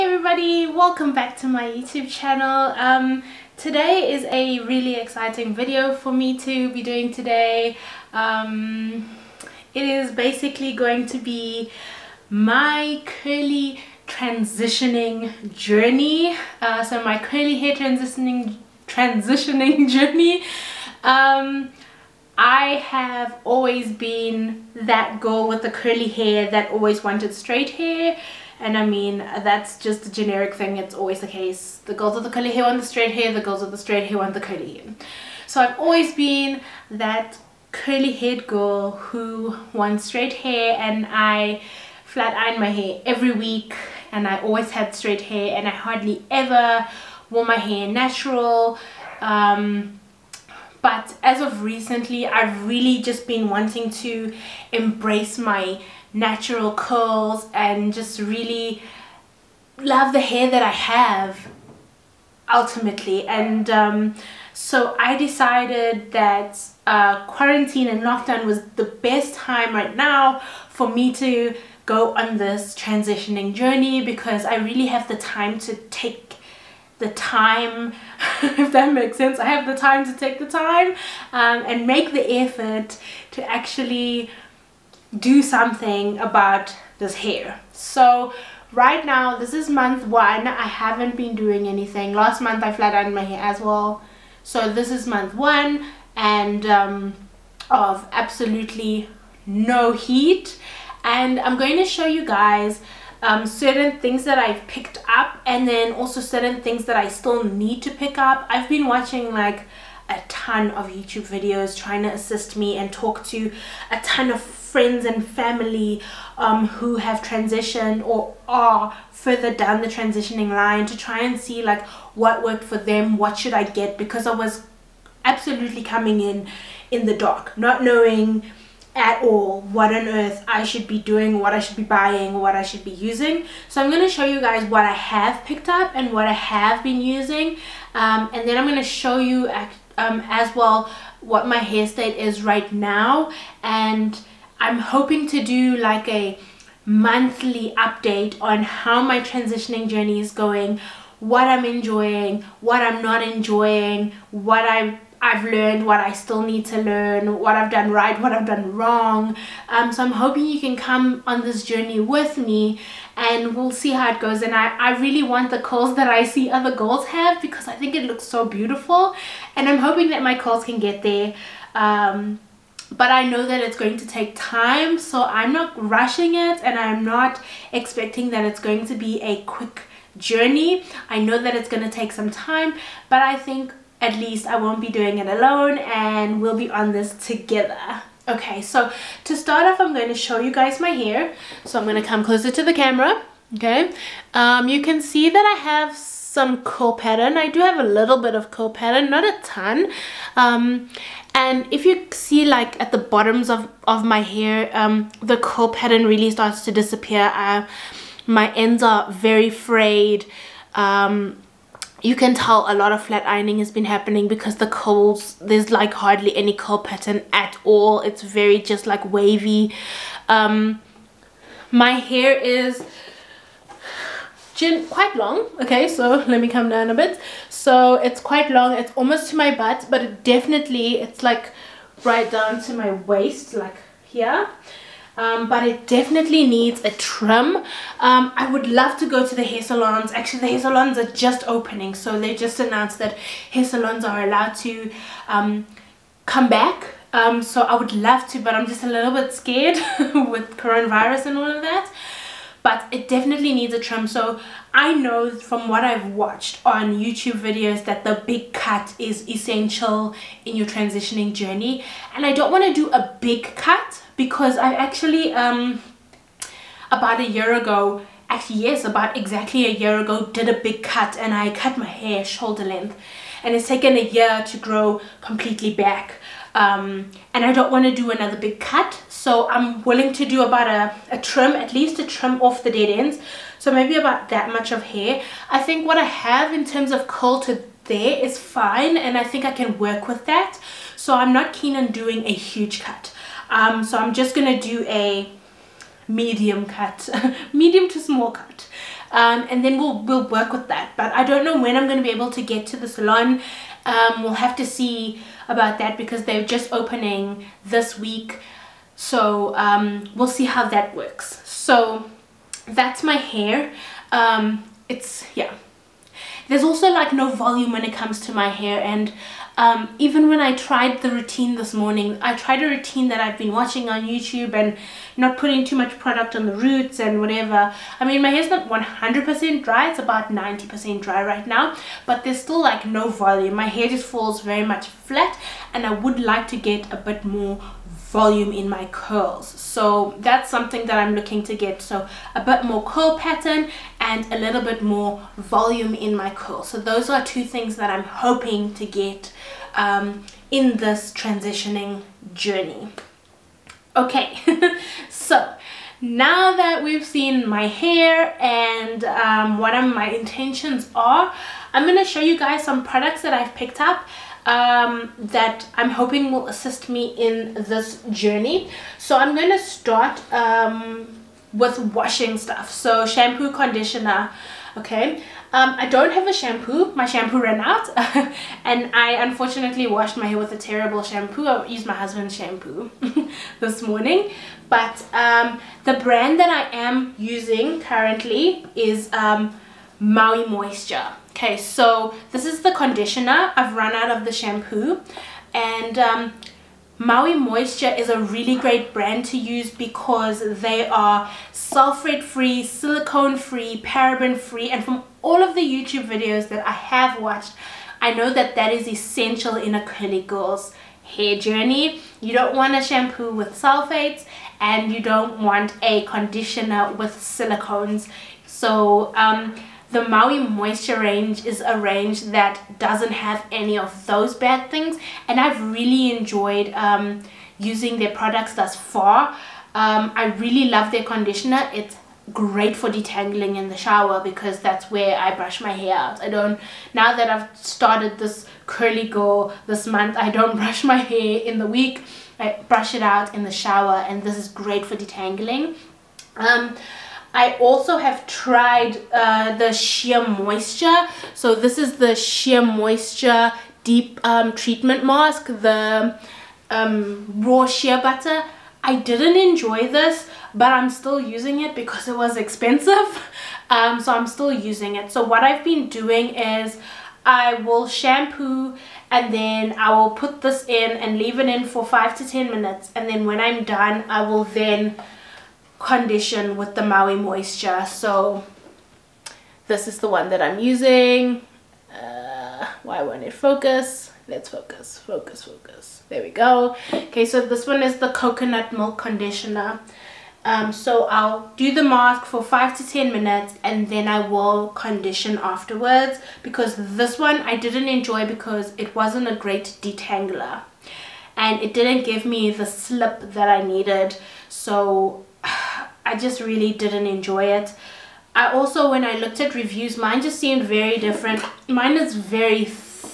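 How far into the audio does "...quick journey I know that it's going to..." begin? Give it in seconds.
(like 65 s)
179 s.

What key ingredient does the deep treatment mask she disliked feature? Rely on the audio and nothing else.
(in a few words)
raw shea butter.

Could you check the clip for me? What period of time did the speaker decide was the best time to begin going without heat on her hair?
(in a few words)
quarantine and lockdown.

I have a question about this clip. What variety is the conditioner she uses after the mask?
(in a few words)
coconut milk.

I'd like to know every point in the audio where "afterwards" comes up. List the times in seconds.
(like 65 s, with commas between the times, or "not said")
495 s.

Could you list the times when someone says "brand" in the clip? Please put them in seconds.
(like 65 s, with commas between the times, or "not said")
385 s, 398 s.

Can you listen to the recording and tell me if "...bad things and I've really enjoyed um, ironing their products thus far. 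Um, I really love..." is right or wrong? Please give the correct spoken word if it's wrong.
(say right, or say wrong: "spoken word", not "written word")
wrong: "using", not "ironing".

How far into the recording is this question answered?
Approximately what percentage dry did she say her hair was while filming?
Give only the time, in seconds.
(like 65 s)
330 s.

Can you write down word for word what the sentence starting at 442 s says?
I brush it out in the shower and this is great for detangling.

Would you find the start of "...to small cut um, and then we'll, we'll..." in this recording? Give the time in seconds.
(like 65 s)
297 s.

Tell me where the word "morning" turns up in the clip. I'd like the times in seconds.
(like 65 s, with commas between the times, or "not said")
321 s, 383 s.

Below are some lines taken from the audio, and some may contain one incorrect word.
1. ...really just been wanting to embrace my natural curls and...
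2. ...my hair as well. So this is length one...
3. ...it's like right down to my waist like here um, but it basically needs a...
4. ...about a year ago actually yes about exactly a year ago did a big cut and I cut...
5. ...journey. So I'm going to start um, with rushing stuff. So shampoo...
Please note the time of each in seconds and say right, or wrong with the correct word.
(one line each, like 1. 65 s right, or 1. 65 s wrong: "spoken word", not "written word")
1. 52 s right
2. 93 s wrong: "month", not "length"
3. 231 s wrong: "definitely", not "basically"
4. 266 s right
5. 368 s wrong: "washing", not "rushing".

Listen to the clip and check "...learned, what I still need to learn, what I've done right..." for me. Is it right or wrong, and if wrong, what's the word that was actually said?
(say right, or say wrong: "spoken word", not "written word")
right.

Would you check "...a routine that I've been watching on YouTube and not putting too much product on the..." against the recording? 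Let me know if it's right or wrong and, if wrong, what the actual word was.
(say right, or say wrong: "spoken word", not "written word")
right.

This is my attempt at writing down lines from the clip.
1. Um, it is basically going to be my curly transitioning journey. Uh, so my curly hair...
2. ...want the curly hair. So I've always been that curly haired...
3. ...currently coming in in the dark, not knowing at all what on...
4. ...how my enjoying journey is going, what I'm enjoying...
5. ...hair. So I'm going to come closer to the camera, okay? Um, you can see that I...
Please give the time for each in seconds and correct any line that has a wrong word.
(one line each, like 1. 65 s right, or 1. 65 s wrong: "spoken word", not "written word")
1. 8 s right
2. 34 s right
3. 125 s wrong: "absolutely", not "currently"
4. 148 s wrong: "transitioning", not "enjoying"
5. 190 s right.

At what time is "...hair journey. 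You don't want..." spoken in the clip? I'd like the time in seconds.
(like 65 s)
411 s.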